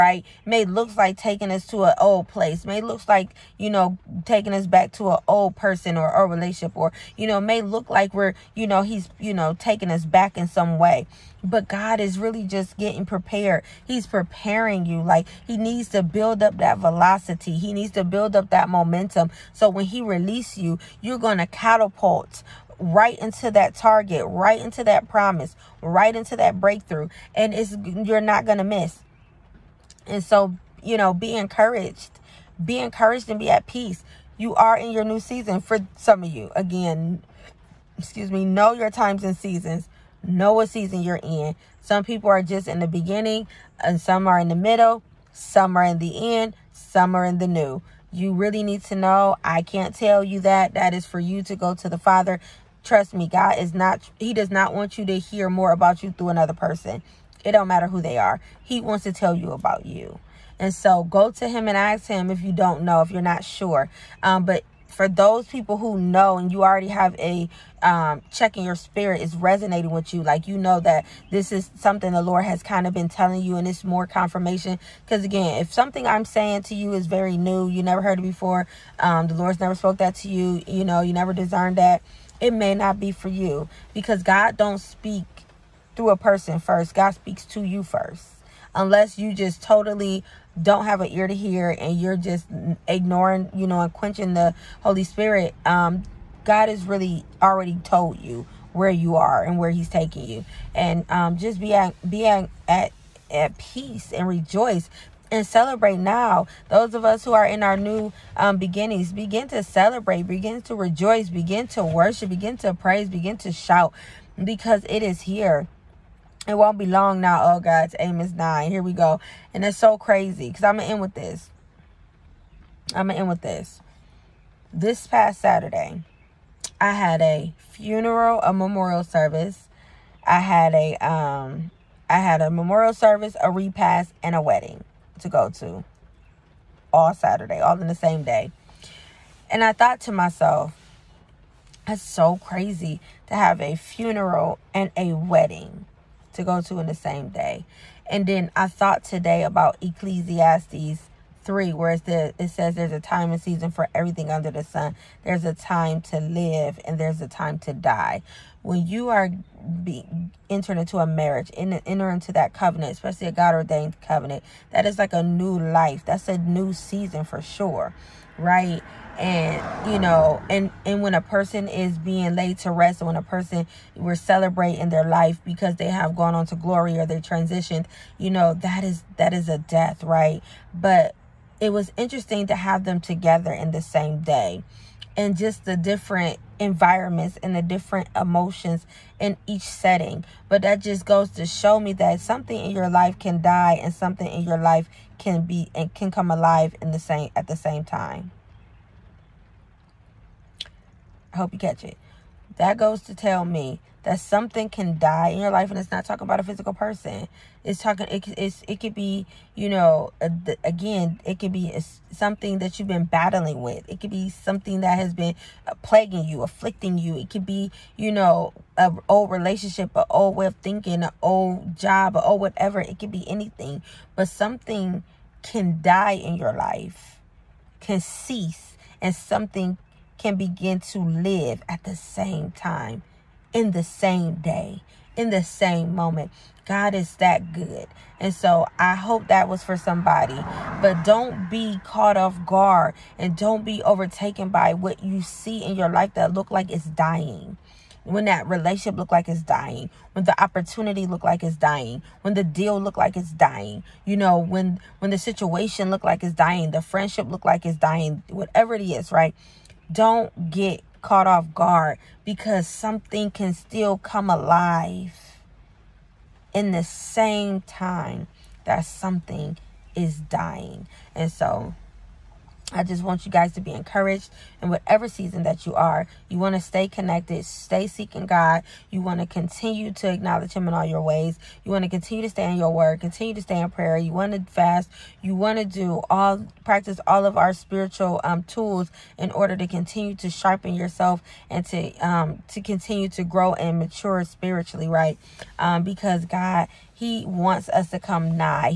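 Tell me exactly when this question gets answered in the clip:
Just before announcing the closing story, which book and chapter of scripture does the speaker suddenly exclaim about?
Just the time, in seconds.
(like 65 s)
117 s.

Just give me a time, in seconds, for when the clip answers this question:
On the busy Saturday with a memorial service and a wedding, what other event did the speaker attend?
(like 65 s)
133 s.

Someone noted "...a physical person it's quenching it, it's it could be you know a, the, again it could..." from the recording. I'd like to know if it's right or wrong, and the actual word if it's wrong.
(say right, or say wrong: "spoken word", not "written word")
wrong: "talking", not "quenching".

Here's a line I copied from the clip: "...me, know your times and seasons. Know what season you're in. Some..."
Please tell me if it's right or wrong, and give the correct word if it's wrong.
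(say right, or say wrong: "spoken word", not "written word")
right.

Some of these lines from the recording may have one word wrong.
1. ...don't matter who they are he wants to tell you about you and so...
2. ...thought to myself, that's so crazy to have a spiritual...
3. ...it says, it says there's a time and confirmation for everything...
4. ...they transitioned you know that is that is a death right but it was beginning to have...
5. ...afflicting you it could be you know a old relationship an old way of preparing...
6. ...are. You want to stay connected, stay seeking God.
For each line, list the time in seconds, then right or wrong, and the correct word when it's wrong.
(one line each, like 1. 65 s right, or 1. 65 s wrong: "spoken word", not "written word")
1. 57 s right
2. 139 s wrong: "funeral", not "spiritual"
3. 151 s wrong: "season", not "confirmation"
4. 177 s wrong: "interesting", not "beginning"
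5. 216 s wrong: "thinking", not "preparing"
6. 275 s right.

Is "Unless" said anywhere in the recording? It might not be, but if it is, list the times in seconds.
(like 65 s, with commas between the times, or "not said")
88 s.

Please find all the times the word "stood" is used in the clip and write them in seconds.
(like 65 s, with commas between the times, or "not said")
not said.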